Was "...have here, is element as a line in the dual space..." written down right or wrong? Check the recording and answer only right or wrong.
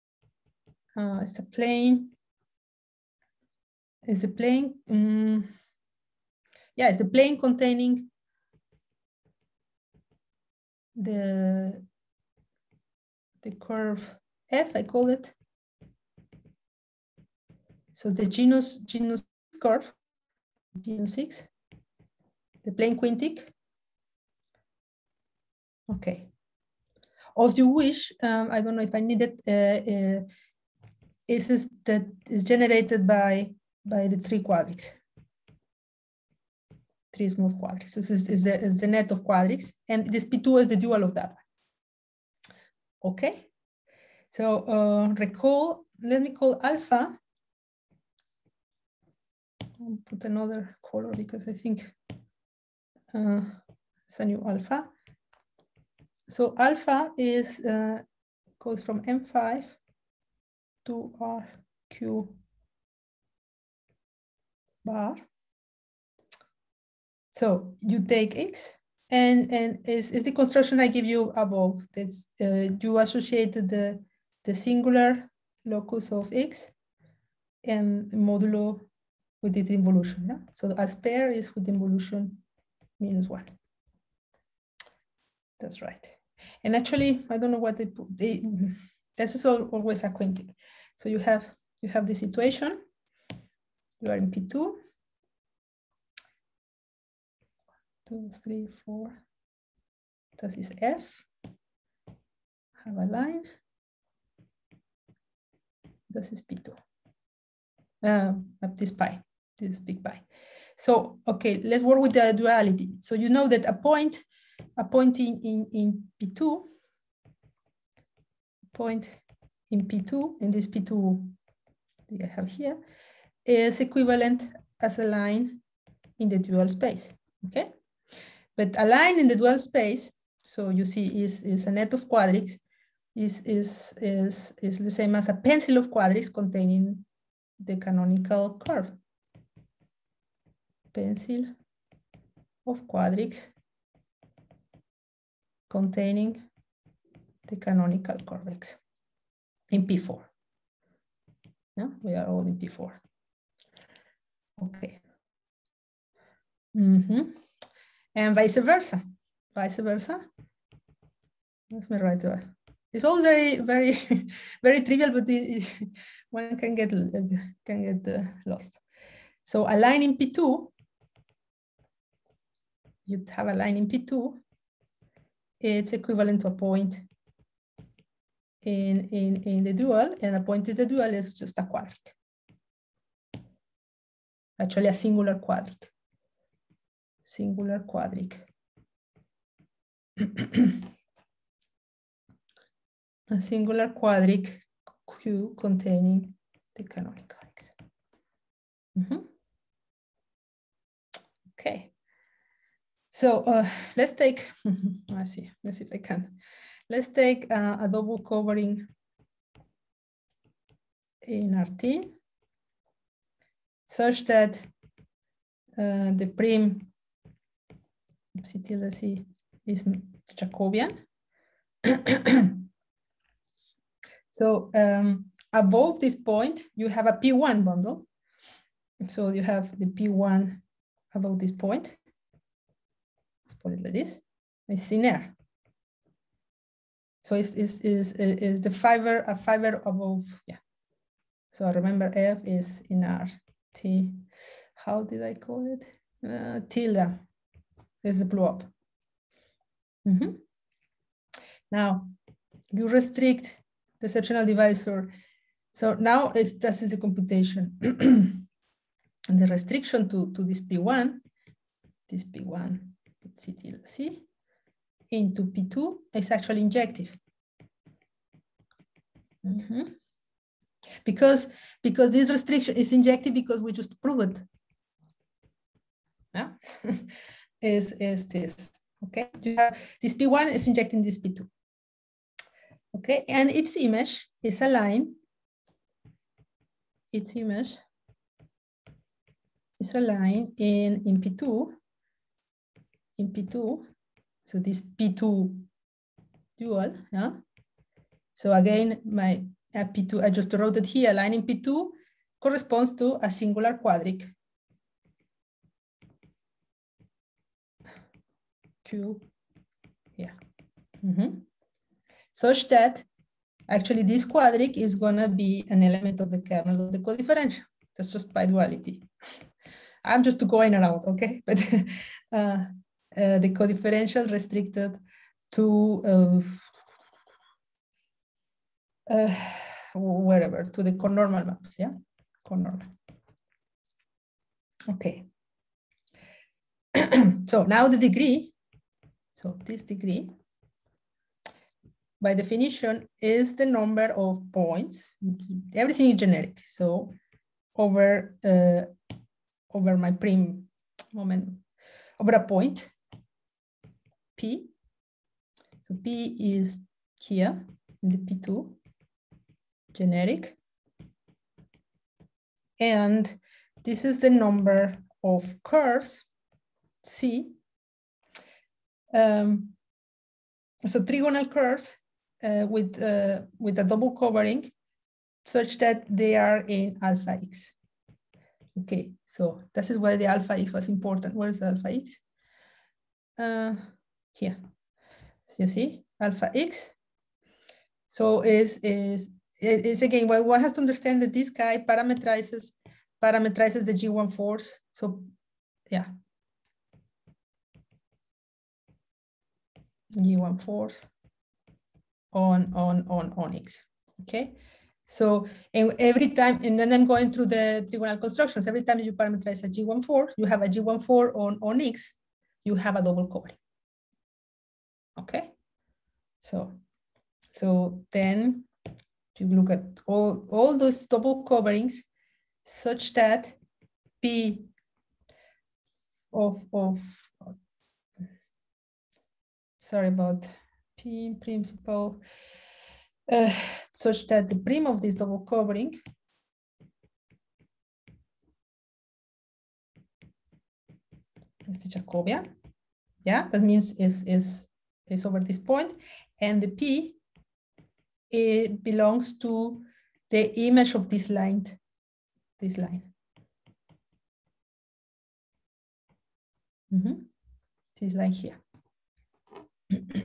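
wrong.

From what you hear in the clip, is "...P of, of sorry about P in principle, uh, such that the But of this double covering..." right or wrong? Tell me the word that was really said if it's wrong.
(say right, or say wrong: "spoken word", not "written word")
wrong: "Prym", not "But".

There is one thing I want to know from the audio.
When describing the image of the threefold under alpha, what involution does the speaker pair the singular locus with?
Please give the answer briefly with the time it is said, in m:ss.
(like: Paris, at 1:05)
minus one, at 1:21.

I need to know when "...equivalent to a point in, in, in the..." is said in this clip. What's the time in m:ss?
2:55.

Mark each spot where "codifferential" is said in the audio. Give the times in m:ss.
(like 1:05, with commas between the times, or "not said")
5:16, 5:23.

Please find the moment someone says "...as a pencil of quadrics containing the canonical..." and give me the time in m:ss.
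2:15.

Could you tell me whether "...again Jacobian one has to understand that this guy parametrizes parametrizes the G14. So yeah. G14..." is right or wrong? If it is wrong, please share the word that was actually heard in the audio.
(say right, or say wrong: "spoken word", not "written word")
wrong: "What", not "Jacobian".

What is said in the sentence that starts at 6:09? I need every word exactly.
Um, so trigonal curves uh, with, uh, with a double covering such that they are in alpha x.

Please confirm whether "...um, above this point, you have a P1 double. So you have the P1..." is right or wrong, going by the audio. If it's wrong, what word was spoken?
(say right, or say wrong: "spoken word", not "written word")
wrong: "bundle", not "double".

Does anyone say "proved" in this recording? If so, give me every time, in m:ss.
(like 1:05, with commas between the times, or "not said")
4:33.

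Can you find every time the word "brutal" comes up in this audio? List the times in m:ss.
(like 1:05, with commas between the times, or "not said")
not said.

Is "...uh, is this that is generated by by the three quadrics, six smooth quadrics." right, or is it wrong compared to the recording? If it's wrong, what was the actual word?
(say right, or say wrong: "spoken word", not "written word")
wrong: "three", not "six".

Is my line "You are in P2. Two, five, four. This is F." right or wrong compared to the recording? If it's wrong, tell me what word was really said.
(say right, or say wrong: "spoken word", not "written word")
wrong: "three", not "five".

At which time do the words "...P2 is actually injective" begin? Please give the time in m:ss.
4:25.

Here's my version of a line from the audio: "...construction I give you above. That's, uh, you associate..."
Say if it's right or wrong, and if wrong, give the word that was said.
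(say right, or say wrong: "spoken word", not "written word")
right.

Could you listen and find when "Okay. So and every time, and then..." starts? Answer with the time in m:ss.
6:44.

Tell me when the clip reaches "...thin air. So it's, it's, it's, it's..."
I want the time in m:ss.
3:54.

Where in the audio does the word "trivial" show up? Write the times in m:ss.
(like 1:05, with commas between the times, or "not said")
2:44.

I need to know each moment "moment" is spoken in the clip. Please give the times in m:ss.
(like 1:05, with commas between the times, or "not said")
5:51.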